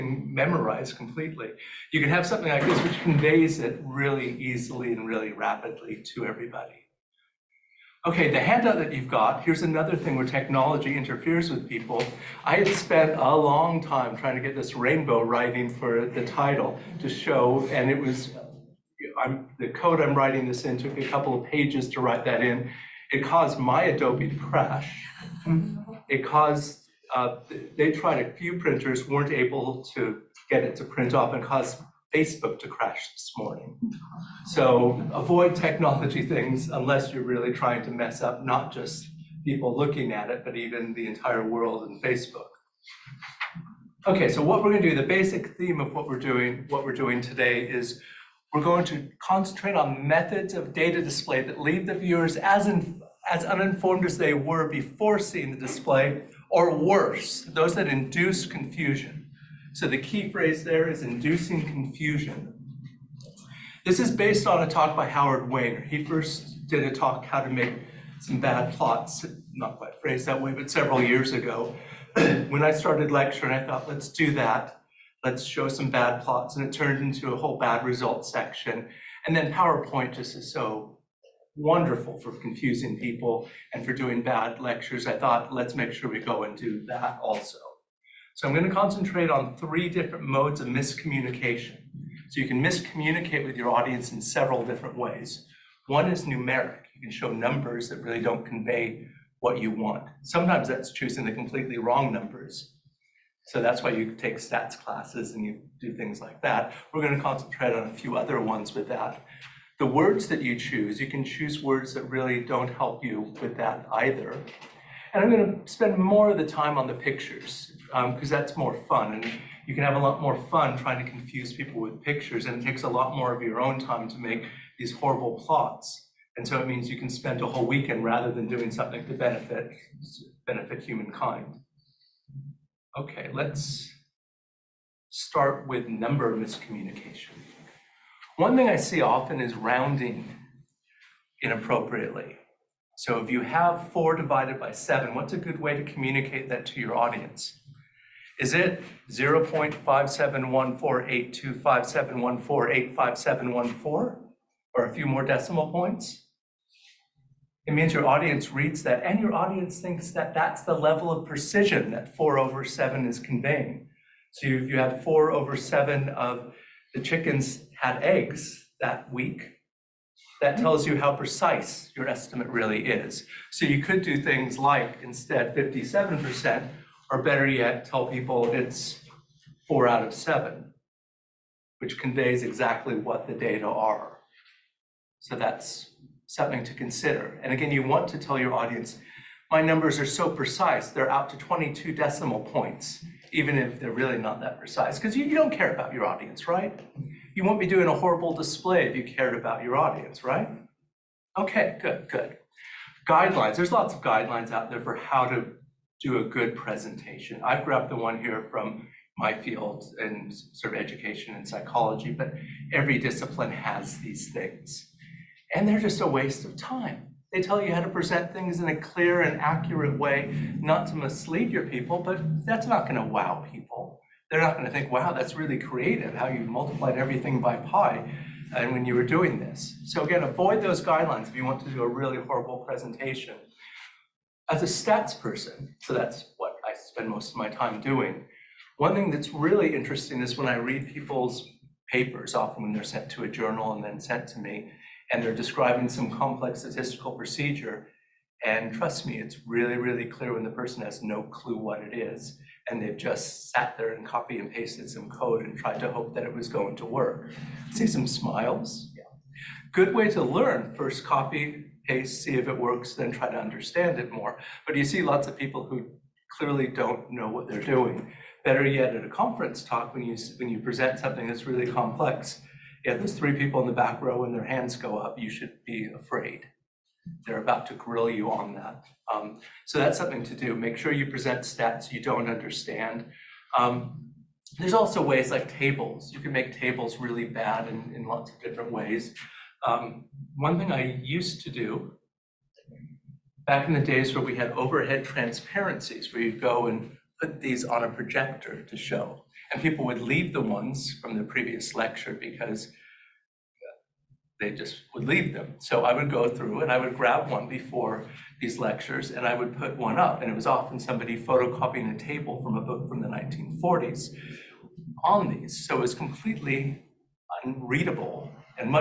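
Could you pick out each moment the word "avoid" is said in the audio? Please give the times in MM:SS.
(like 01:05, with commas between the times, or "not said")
00:35, 03:50.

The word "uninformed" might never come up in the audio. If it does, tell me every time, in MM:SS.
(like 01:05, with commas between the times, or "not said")
00:53.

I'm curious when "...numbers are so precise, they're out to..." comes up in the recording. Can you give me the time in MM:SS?
03:09.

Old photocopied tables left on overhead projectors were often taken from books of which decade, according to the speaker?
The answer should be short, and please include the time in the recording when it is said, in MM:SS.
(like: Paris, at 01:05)
1940s, at 05:13.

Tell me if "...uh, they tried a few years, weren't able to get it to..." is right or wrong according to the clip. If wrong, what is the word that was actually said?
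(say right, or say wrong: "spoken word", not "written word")
wrong: "printers", not "years".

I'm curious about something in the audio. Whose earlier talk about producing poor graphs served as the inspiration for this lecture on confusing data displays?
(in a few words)
Howard Wayner.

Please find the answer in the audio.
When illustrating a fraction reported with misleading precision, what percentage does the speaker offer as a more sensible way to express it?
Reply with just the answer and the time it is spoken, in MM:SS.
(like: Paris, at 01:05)
57%, at 02:55.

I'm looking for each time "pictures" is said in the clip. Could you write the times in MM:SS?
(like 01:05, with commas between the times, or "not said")
01:56, 02:02.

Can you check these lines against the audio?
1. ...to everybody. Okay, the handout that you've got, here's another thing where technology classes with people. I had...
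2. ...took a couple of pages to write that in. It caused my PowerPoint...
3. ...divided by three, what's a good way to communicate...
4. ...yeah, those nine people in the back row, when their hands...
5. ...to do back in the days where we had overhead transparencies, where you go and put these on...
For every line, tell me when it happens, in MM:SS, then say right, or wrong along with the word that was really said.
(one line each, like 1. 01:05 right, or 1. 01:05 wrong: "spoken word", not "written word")
1. 00:06 wrong: "interferes", not "classes"
2. 00:20 wrong: "Adobe", not "PowerPoint"
3. 02:24 wrong: "seven", not "three"
4. 04:32 wrong: "three", not "nine"
5. 04:51 right.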